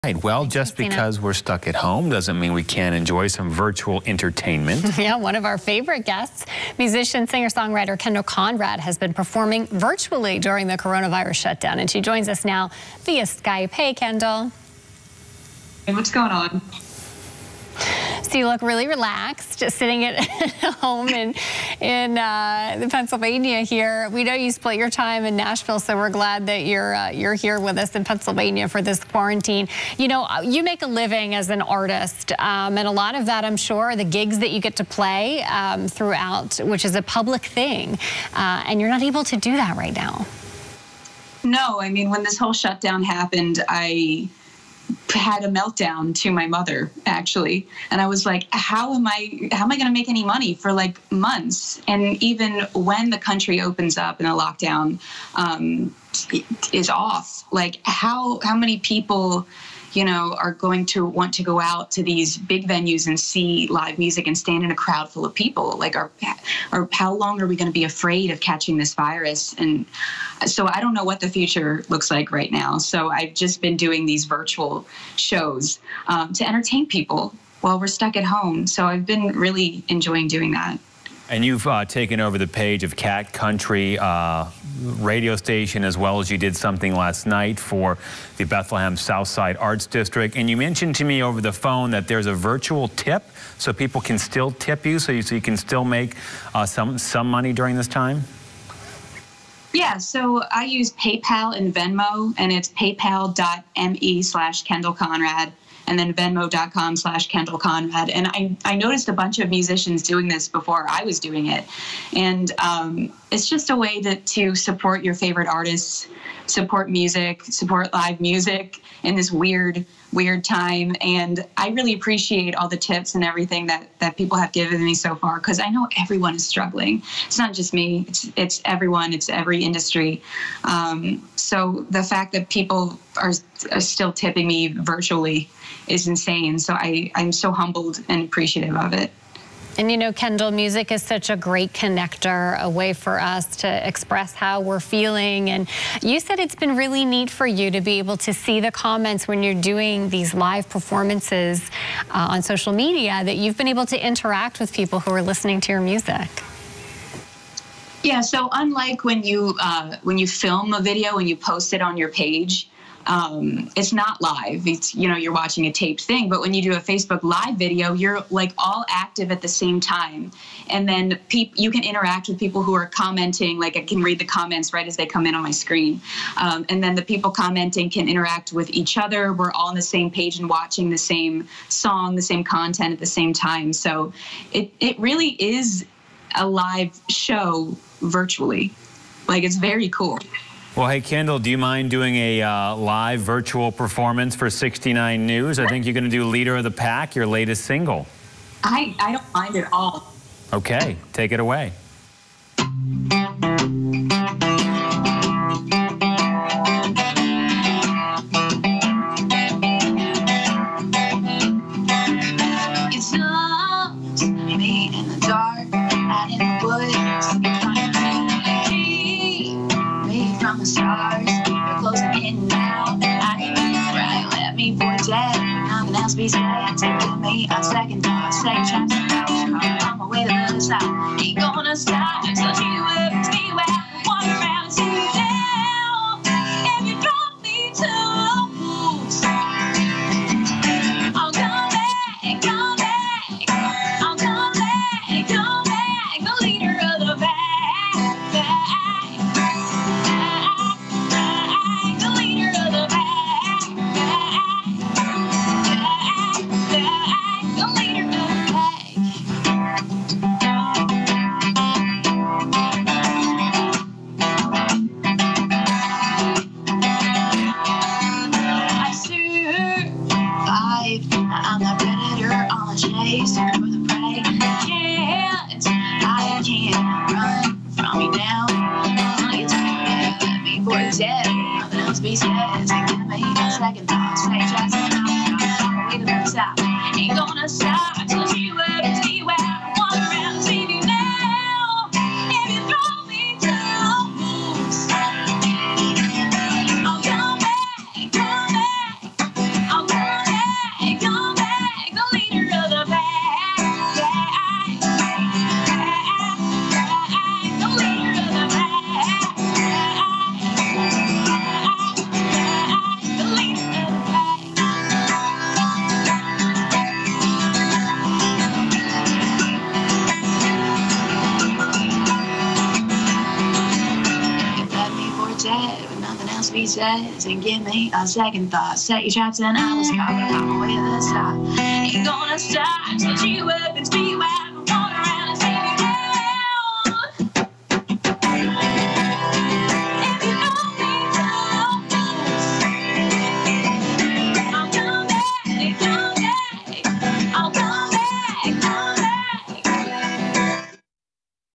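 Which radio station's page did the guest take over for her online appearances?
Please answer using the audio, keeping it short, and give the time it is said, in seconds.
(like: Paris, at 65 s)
Cat Country, at 82 s.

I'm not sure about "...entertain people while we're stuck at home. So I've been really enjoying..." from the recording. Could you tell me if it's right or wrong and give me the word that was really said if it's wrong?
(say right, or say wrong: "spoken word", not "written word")
right.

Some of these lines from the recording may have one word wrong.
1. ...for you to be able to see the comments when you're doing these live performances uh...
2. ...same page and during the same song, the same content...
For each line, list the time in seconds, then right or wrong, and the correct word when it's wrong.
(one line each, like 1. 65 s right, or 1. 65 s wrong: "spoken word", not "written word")
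1. 147 s right
2. 179 s wrong: "watching", not "during".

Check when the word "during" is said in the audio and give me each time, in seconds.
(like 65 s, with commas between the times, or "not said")
10 s, 97 s.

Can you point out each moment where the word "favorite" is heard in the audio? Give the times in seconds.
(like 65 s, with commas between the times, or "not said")
5 s, 115 s.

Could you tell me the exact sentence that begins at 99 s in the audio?
Yeah, so I use PayPal and Venmo, and it's paypal.me slash Kendal Conrad and then venmo.com slash Kendal Conrad.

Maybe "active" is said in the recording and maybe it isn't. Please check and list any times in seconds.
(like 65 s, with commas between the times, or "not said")
168 s.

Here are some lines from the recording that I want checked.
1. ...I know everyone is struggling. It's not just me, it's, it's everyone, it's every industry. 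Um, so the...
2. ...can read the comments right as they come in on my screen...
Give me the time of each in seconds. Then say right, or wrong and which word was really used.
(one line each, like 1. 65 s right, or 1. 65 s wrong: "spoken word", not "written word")
1. 125 s right
2. 173 s right.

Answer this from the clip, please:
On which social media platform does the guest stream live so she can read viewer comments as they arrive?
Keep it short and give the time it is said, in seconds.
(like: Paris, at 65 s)
Facebook, at 166 s.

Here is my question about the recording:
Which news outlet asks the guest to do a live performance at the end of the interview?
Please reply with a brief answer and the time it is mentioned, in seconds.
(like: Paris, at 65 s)
69 News, at 194 s.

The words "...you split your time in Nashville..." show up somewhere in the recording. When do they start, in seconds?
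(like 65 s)
24 s.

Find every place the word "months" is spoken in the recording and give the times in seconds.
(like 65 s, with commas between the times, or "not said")
51 s.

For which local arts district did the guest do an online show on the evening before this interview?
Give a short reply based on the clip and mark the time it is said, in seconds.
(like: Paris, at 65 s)
Bethlehem Southside Arts District, at 88 s.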